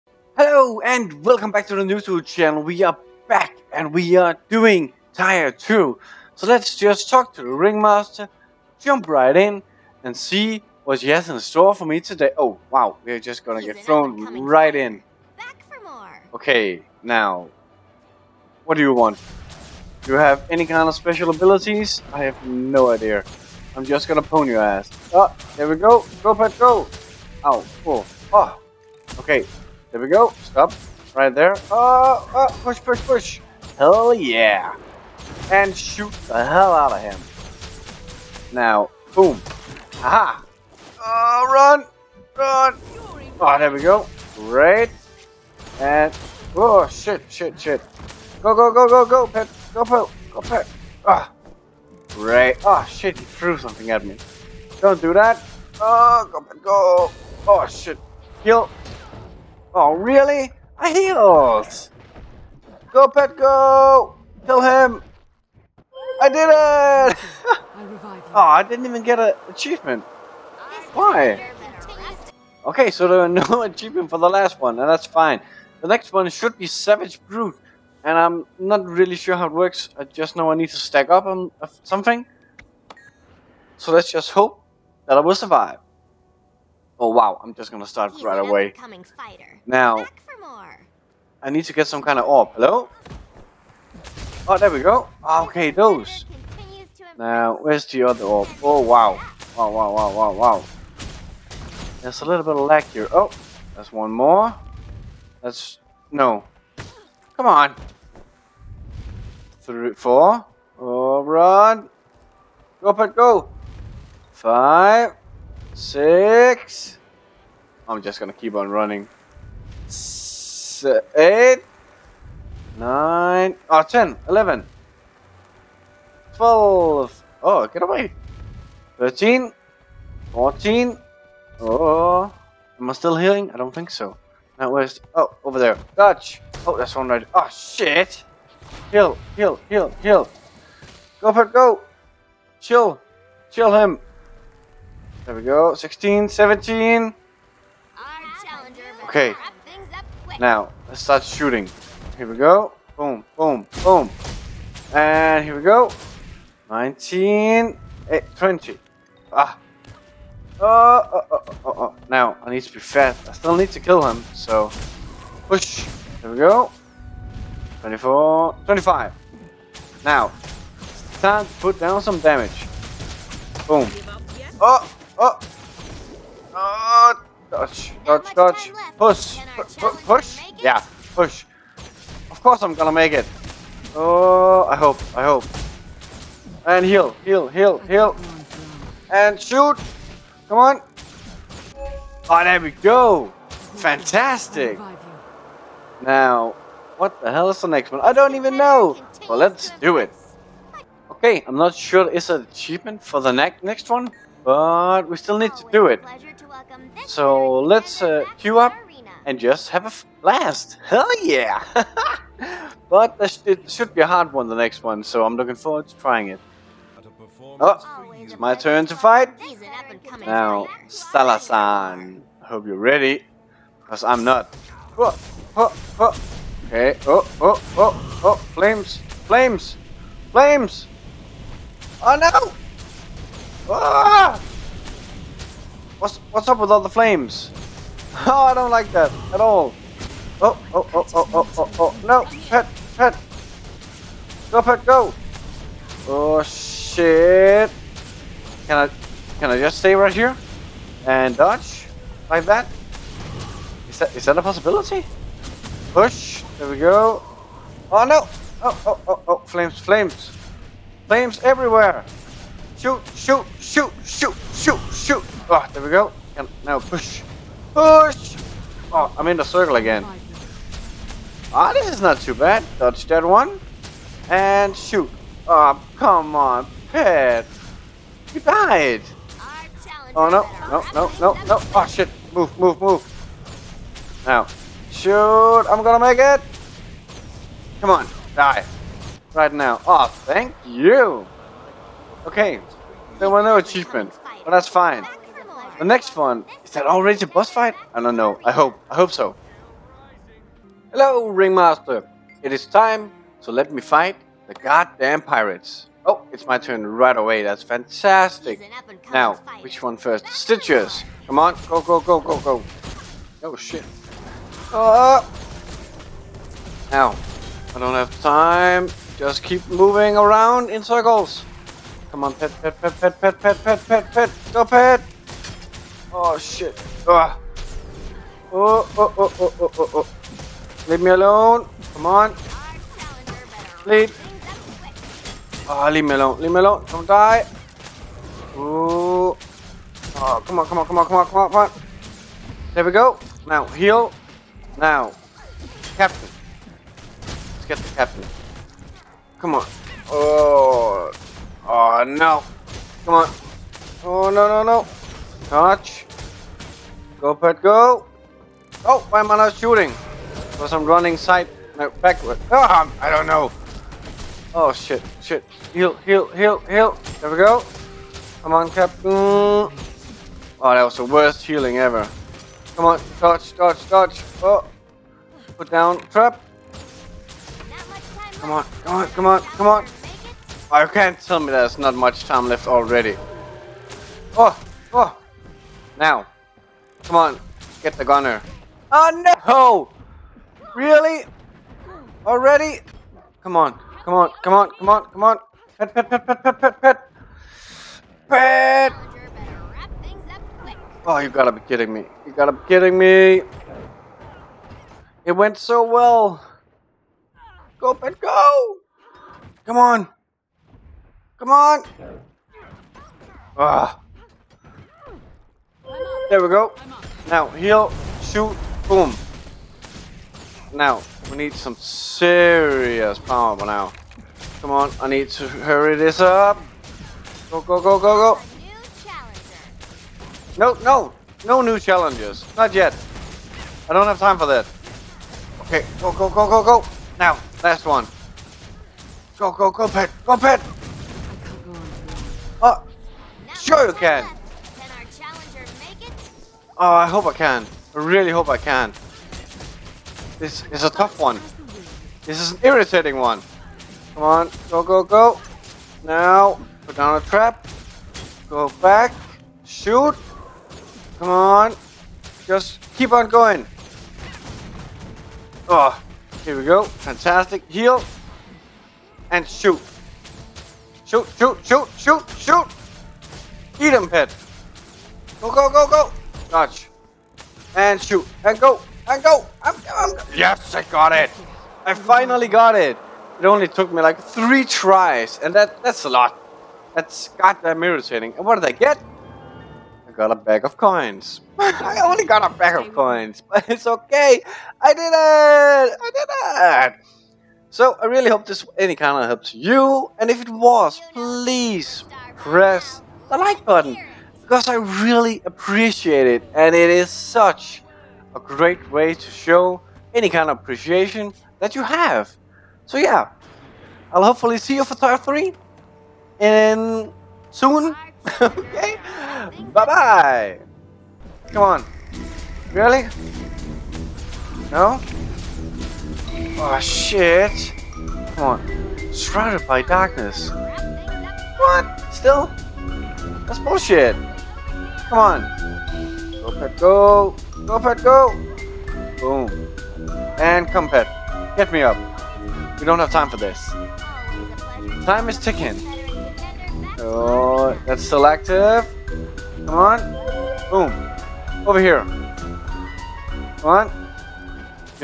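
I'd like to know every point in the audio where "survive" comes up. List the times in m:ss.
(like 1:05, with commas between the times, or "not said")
1:25.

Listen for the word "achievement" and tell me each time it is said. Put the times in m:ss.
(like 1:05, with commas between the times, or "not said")
1:09, 1:13, 3:22, 4:53.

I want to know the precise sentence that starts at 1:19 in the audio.
I just know I need to stack up on something.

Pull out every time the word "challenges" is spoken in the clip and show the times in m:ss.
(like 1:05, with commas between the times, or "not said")
7:11.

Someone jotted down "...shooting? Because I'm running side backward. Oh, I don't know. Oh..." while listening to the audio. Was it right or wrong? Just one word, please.
right.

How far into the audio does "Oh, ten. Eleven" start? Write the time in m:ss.
2:03.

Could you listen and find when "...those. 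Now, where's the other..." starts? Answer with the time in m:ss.
1:35.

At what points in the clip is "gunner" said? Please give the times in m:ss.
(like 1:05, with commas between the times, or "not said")
6:28.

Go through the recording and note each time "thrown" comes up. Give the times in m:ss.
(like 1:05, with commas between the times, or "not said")
0:13.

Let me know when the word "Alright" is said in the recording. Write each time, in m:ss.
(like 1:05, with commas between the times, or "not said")
1:50.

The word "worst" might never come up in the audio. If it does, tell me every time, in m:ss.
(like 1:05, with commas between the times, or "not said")
6:11.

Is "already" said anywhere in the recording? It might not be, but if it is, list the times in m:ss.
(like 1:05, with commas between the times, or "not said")
4:56, 6:22, 6:32.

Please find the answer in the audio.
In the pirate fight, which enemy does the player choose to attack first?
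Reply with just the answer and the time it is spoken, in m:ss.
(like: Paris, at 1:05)
Stitches, at 5:10.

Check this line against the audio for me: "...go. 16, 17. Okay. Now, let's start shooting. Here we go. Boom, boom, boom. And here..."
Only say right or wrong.
right.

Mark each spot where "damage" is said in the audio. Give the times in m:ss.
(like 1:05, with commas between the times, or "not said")
2:52.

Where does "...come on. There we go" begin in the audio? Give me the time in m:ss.
5:41.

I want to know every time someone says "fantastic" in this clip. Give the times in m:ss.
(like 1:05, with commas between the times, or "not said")
3:13, 5:07, 7:46.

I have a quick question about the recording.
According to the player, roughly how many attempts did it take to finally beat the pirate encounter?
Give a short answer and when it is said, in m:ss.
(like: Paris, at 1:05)
3 tries, at 8:04.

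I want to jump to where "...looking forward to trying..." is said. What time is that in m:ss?
3:35.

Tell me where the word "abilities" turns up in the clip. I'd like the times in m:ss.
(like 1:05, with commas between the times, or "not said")
0:21.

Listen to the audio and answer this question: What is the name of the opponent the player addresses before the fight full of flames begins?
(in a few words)
Salazan.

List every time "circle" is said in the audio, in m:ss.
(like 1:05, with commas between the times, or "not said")
4:29, 5:20.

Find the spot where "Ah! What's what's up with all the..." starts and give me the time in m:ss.
3:53.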